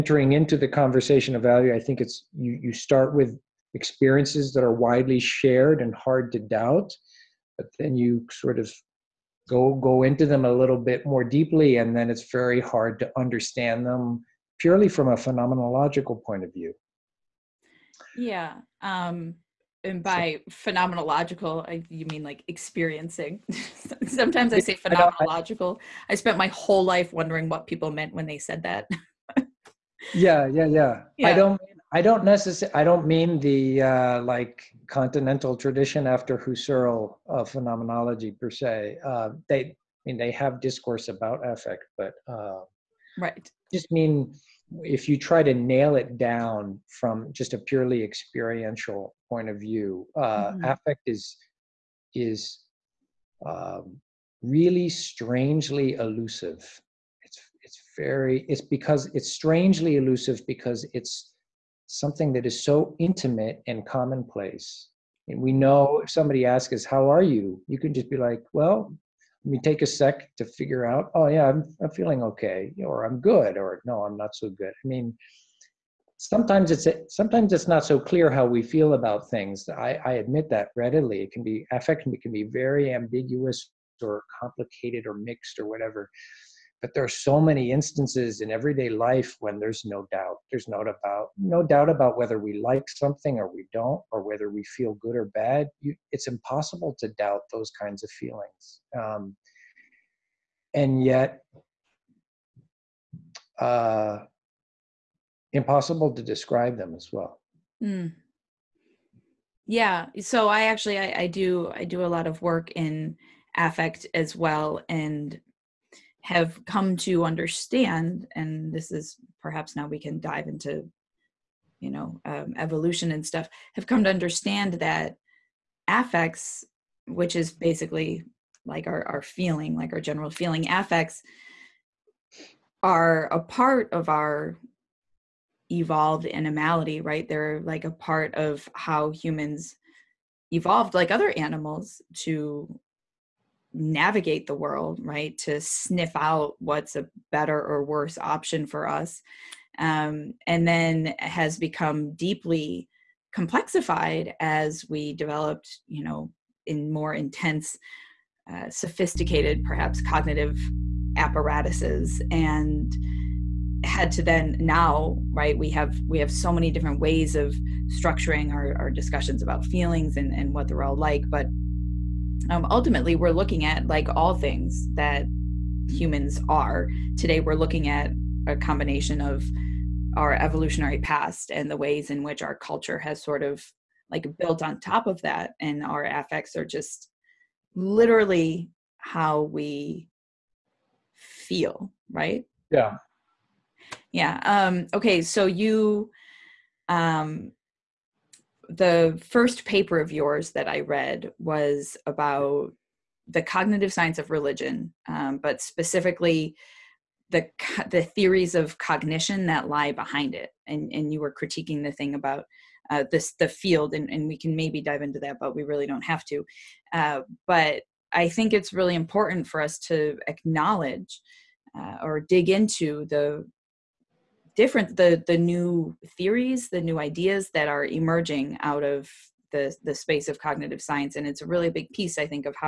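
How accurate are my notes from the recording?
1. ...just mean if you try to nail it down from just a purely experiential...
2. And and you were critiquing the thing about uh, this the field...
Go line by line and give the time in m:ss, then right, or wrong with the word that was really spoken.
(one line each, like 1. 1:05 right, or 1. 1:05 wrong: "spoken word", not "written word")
1. 0:43 right
2. 3:30 right.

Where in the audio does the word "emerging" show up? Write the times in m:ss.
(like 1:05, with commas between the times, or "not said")
3:47.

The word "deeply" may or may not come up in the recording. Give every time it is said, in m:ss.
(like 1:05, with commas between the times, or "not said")
0:11, 2:32.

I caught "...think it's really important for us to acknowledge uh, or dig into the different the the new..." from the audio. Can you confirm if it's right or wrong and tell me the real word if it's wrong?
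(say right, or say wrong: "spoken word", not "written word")
right.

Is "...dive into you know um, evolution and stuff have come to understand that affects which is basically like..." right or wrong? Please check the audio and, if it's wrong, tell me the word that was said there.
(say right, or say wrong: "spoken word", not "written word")
right.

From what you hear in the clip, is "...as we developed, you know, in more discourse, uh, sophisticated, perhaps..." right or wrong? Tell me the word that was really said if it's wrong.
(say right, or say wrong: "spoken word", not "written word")
wrong: "intense", not "discourse".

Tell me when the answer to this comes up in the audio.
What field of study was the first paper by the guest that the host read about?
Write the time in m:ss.
3:23.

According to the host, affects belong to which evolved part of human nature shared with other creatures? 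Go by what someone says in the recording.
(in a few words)
Our evolved animality.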